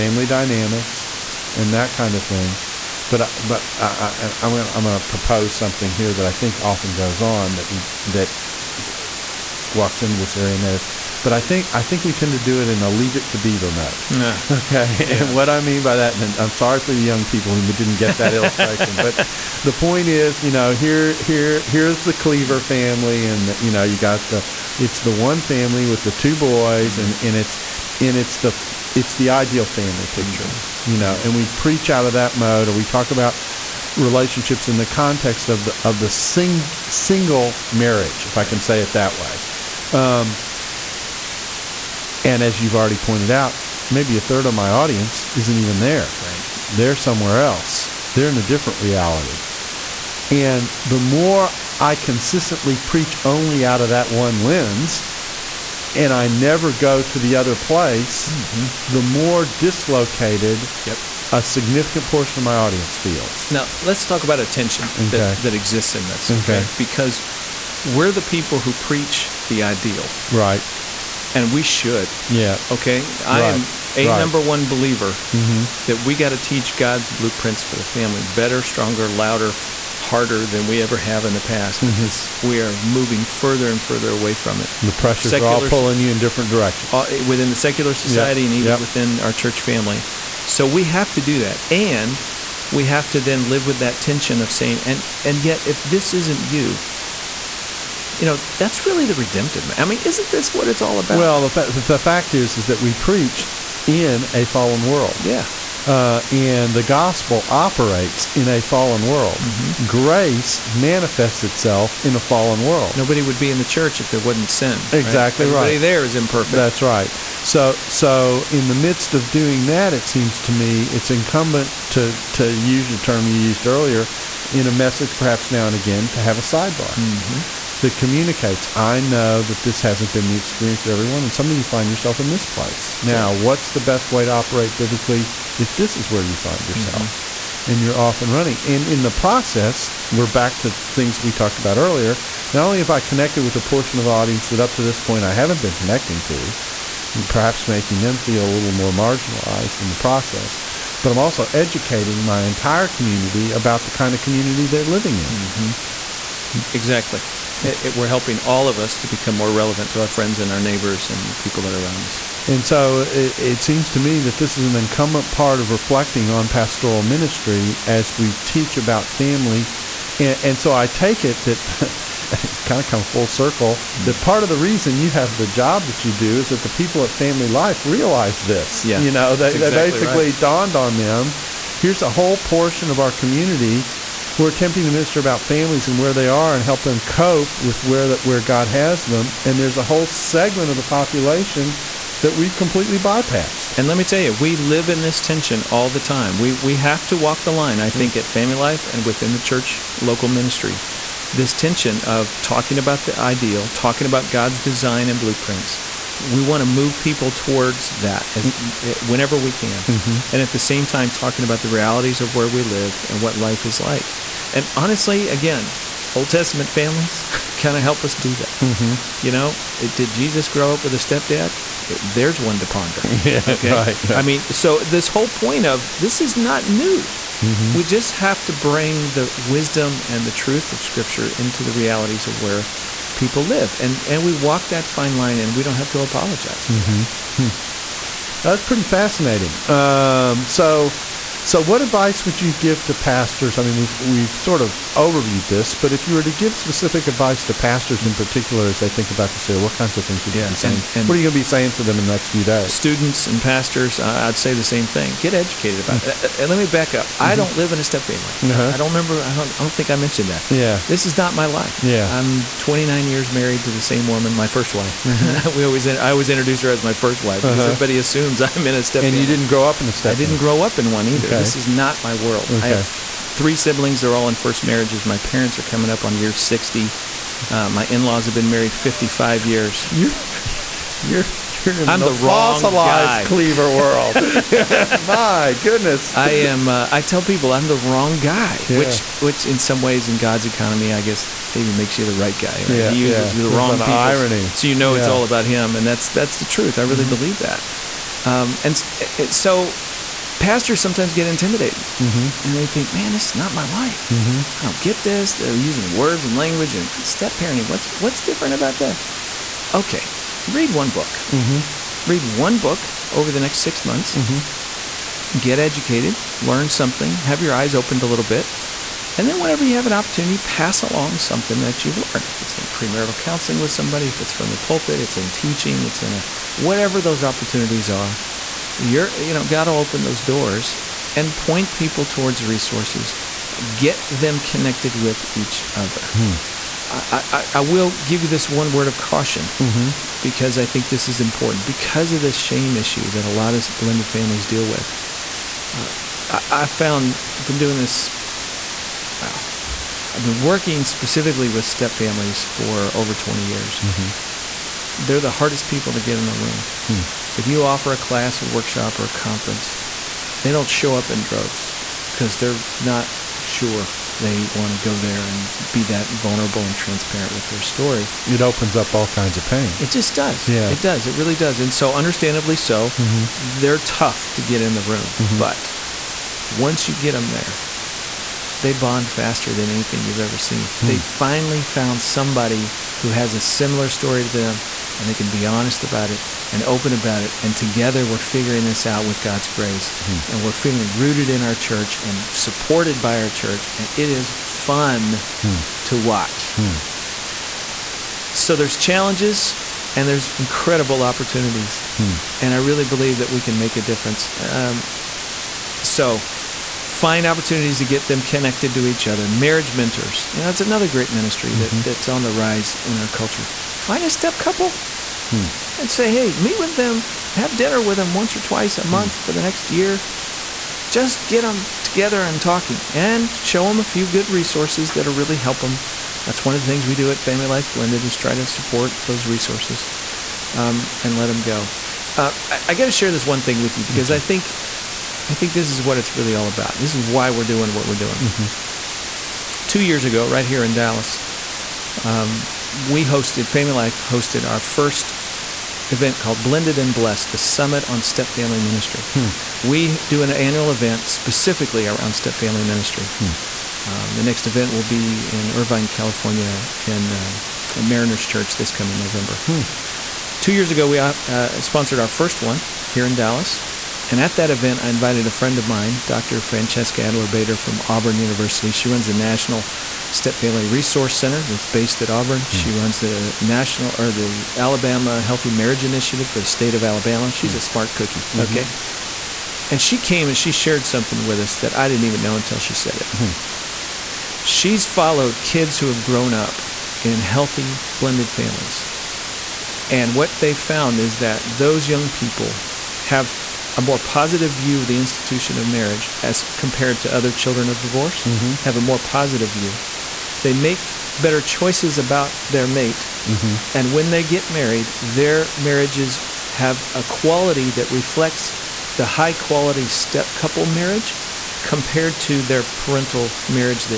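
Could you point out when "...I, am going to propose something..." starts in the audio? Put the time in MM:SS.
00:03.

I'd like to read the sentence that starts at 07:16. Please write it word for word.
This is why we're doing what we're doing.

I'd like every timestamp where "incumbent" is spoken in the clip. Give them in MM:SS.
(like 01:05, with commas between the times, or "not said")
02:01, 02:44.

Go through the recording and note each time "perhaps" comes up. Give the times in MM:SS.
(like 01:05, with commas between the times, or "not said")
02:05, 02:27.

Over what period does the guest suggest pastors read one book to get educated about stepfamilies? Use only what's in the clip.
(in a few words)
six months.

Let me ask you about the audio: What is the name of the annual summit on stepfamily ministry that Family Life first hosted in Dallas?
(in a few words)
Blended and Blessed.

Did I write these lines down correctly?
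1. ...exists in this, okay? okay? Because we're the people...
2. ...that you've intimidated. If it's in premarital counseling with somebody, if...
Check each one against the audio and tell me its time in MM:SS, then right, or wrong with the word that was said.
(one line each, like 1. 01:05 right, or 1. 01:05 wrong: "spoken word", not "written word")
1. 01:05 right
2. 05:21 wrong: "learned", not "intimidated".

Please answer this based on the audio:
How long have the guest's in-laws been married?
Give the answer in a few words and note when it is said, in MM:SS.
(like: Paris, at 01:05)
55 years, at 04:38.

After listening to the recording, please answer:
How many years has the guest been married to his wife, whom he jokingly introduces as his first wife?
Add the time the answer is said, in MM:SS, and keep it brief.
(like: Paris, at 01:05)
29, at 04:22.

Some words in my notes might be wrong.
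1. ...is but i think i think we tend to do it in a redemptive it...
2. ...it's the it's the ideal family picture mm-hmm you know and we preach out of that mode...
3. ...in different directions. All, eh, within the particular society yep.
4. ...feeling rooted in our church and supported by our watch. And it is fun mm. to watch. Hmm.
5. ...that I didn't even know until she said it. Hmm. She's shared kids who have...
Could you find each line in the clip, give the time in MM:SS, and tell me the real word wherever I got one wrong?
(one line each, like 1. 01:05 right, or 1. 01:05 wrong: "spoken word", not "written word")
1. 00:10 wrong: "leave", not "redemptive"
2. 00:28 right
3. 01:26 wrong: "secular", not "particular"
4. 06:30 wrong: "church", not "watch"
5. 08:01 wrong: "followed", not "shared".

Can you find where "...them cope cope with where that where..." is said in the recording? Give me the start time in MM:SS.
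03:06.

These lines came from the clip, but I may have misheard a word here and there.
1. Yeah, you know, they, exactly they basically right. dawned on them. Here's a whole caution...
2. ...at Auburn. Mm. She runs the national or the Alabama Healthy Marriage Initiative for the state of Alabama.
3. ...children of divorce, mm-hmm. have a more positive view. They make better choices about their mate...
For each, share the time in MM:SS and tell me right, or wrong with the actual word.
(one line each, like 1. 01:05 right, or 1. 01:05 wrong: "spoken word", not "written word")
1. 02:58 wrong: "portion", not "caution"
2. 07:51 right
3. 08:17 right.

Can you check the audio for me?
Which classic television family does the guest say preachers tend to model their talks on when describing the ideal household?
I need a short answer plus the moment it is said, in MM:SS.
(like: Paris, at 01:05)
Cleaver family, at 00:22.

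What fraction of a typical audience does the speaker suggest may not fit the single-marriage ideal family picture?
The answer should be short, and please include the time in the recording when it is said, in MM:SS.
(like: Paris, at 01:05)
a third, at 00:44.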